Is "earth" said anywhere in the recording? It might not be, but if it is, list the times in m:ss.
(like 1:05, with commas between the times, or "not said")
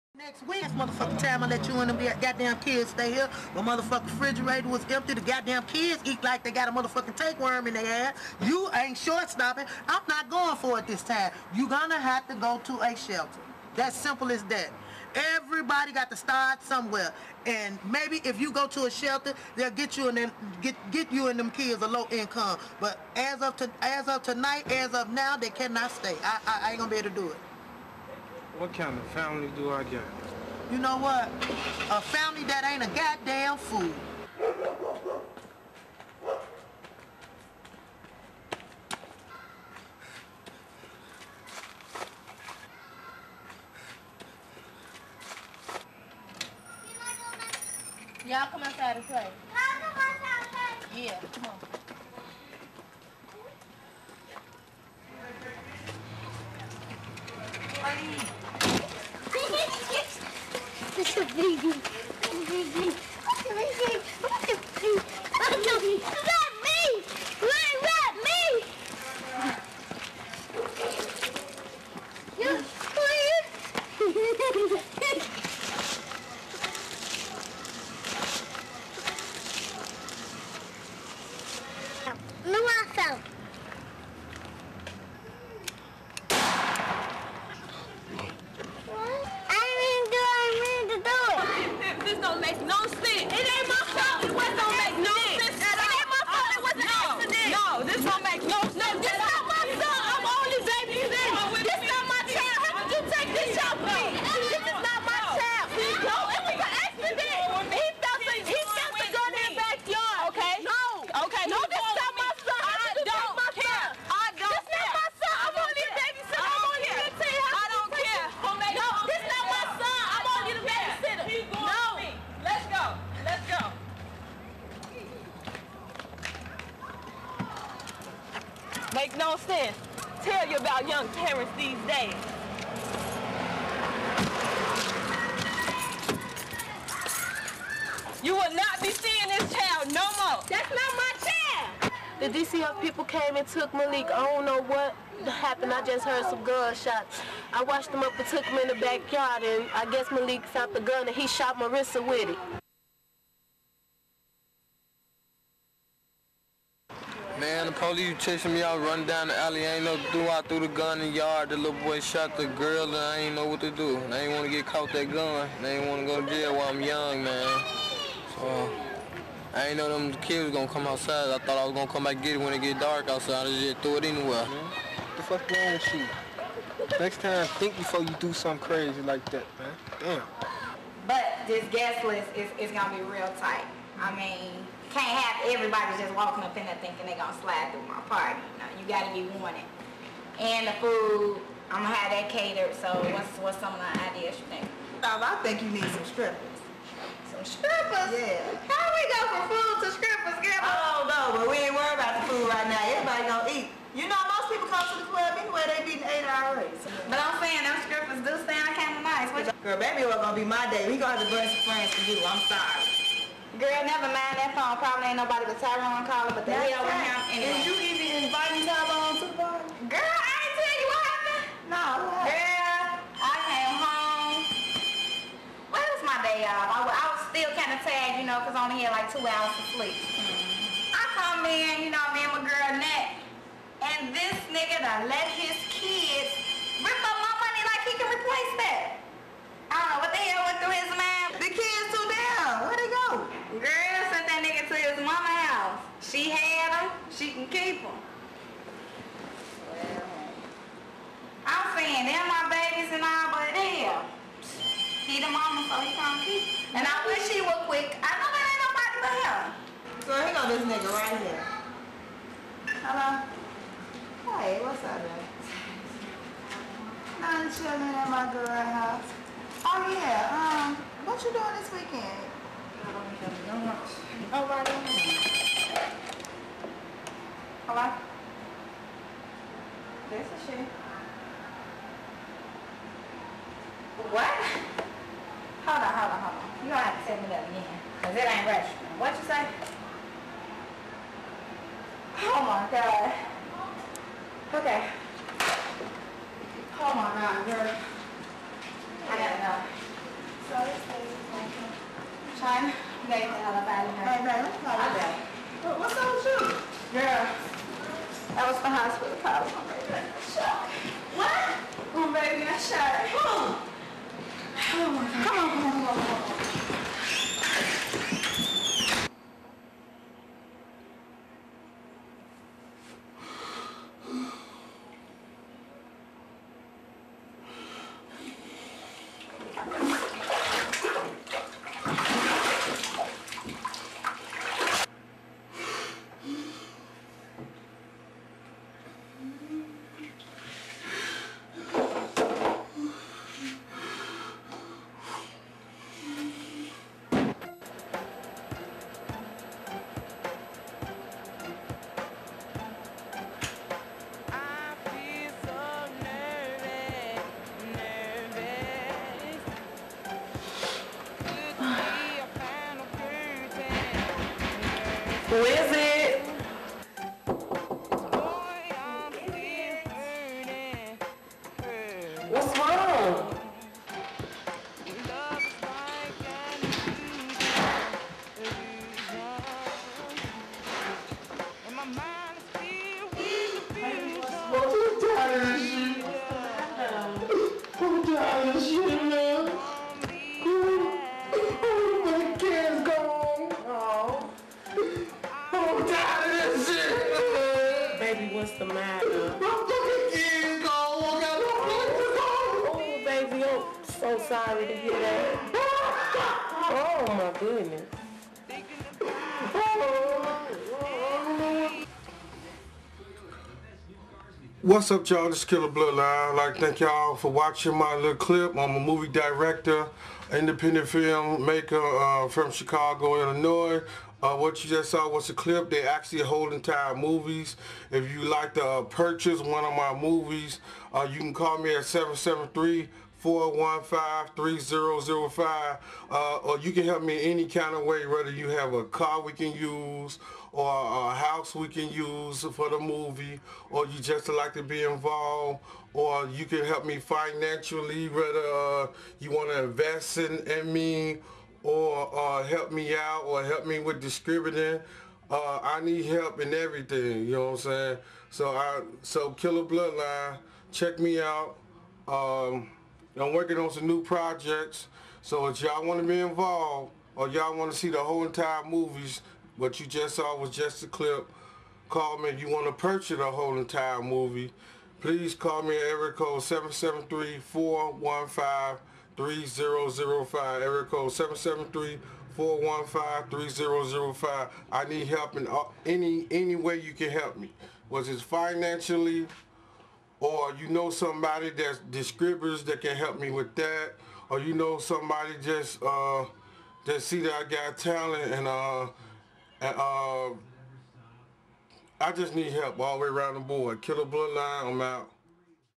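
not said.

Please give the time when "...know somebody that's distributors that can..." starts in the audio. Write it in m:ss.
8:10.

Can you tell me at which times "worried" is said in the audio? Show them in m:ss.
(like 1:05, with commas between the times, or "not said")
3:21.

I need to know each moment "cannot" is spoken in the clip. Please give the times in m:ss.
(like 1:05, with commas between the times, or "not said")
0:25.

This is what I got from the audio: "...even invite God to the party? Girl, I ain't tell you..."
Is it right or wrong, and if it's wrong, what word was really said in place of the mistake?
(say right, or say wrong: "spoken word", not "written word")
wrong: "Tyrone", not "God".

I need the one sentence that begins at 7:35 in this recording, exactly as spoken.
Uh, I need help in everything, you know what I'm saying?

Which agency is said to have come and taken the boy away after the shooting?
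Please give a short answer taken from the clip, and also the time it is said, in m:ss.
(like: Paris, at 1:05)
DCF, at 2:22.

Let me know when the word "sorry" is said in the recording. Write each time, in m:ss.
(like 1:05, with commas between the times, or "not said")
3:32, 6:44.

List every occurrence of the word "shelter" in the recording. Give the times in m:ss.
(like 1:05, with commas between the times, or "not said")
0:12, 0:18.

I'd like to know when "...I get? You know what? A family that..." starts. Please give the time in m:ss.
0:29.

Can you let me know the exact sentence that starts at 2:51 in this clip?
I thought I was gonna come back and get it when it get dark outside.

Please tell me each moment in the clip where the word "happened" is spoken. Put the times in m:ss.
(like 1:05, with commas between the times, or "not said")
2:25, 3:41.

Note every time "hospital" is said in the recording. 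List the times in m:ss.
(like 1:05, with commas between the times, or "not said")
5:08.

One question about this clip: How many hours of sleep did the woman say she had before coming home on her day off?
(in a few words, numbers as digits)
2.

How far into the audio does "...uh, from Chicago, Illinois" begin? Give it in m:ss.
7:01.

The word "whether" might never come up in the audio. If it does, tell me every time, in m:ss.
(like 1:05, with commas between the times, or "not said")
7:18, 7:28.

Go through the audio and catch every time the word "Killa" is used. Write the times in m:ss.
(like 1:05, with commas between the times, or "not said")
6:55, 7:39, 8:23.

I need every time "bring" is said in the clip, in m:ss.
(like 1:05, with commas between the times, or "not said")
3:31.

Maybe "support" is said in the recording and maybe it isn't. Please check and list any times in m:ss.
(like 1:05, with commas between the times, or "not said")
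not said.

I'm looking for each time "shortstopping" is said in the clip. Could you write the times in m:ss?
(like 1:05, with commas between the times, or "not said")
0:08.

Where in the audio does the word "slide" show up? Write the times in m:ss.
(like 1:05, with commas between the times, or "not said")
3:07.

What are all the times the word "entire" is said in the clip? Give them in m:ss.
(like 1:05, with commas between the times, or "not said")
7:06, 7:48, 7:53.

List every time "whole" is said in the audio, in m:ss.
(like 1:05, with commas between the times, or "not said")
7:47, 7:53.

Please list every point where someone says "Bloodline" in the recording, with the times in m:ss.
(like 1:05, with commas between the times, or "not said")
6:55, 7:39, 8:24.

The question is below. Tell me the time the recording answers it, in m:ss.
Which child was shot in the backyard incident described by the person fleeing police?
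2:31.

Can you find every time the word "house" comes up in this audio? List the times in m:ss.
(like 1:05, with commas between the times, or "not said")
4:28, 7:21.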